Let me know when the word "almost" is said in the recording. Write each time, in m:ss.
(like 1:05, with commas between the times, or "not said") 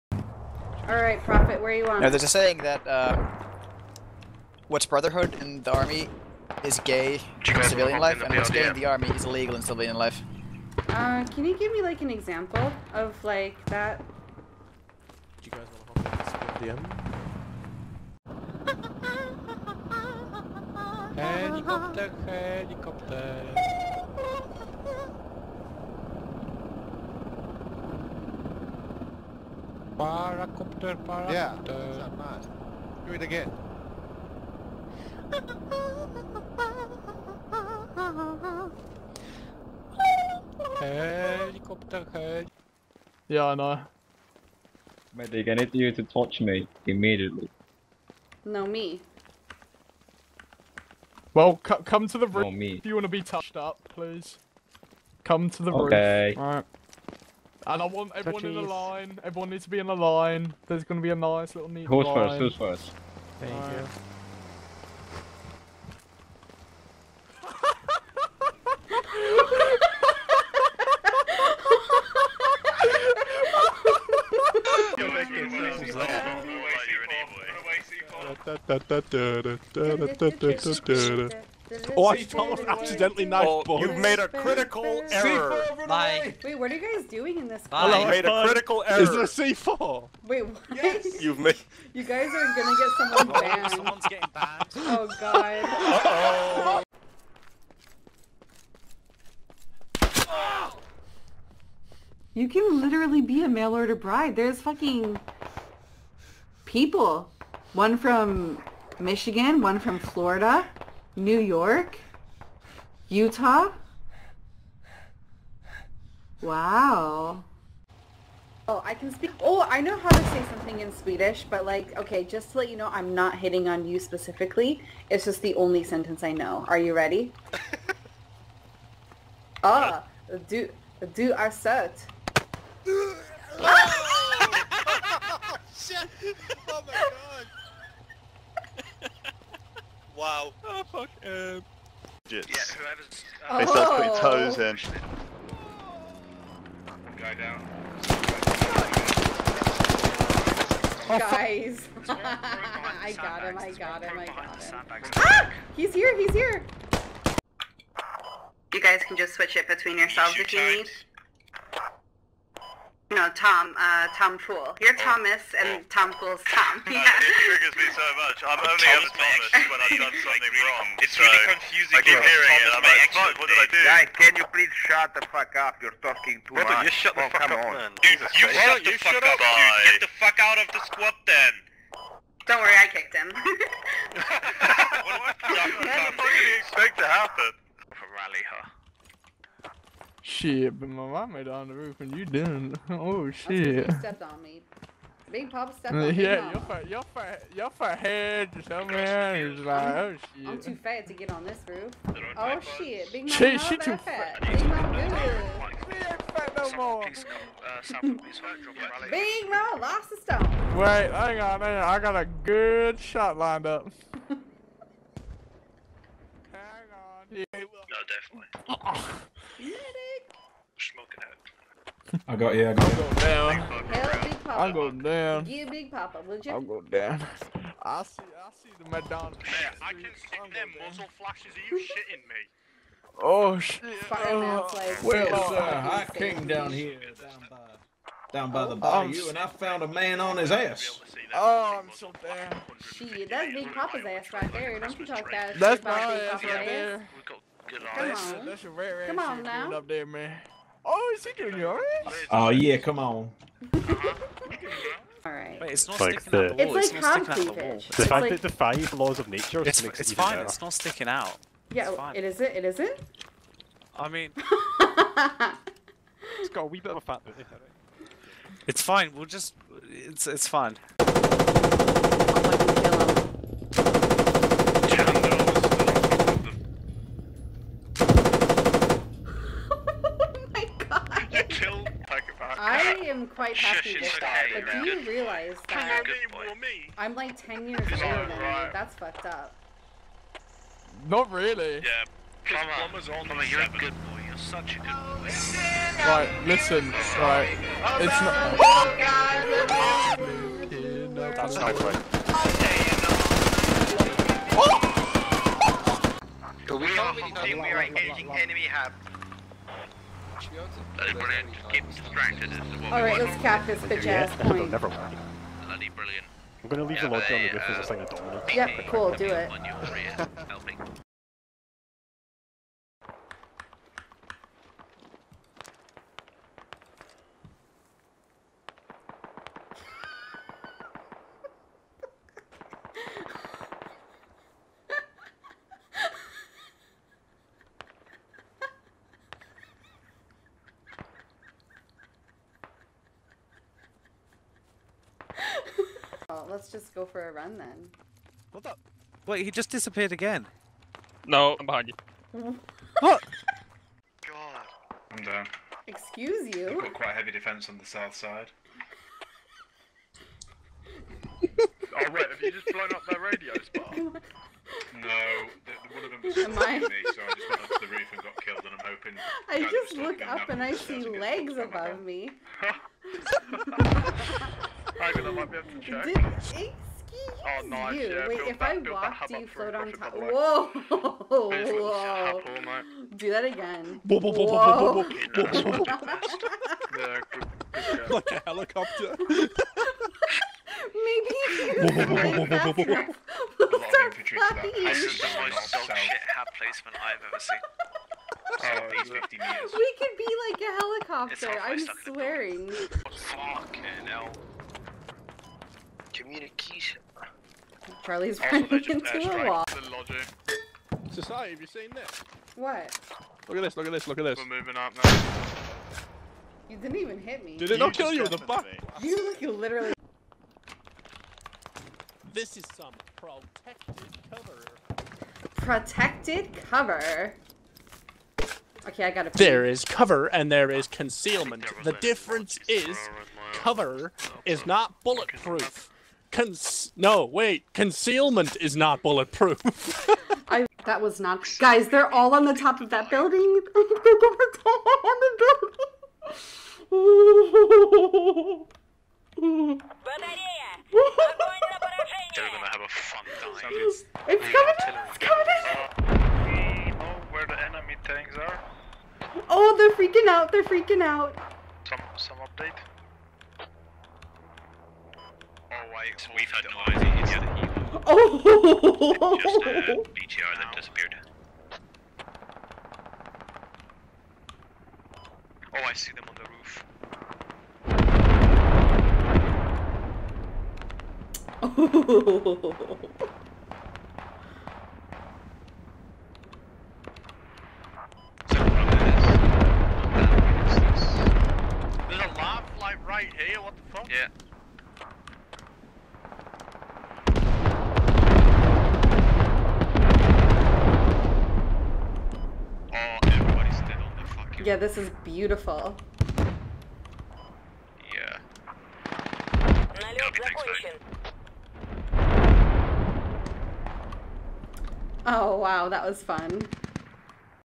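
1:22.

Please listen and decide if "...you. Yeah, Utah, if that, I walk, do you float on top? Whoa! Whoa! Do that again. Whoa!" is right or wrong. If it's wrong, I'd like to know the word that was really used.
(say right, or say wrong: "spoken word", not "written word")
wrong: "Wait", not "Utah".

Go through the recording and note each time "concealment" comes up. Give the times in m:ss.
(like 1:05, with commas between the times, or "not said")
7:10, 7:17.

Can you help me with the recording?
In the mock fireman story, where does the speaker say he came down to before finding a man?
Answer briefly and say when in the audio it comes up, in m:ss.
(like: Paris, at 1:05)
the bayou, at 3:58.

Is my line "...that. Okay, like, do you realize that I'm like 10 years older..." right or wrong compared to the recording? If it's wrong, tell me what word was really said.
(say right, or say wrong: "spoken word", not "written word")
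right.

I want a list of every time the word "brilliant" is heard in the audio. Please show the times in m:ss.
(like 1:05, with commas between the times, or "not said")
5:11, 5:15.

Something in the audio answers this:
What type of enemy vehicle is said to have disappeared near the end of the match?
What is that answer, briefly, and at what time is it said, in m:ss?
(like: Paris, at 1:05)
BTR, at 7:50.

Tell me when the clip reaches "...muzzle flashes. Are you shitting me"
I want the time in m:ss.
3:50.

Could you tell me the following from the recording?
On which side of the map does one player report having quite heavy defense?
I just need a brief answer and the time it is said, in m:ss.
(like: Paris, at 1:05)
south side, at 5:57.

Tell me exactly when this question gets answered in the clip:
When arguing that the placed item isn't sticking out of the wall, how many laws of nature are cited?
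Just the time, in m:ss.
4:18.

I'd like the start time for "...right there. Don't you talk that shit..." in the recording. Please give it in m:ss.
4:04.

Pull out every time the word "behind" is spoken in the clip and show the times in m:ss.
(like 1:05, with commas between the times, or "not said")
5:51, 6:06.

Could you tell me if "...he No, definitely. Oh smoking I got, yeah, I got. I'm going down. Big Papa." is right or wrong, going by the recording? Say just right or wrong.
right.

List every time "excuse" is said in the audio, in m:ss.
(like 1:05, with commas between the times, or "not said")
5:55, 6:16.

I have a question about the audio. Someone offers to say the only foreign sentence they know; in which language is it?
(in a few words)
Swedish.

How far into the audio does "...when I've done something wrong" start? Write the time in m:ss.
2:49.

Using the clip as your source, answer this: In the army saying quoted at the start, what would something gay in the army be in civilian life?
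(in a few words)
illegal.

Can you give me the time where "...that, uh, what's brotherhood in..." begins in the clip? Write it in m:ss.
0:02.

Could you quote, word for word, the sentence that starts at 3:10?
shit, but my mom made it on the roof and you didn't.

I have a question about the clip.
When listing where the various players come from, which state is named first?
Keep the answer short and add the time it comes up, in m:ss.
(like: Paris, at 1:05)
Michigan, at 1:49.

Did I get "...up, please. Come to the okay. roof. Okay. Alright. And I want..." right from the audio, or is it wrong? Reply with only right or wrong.
right.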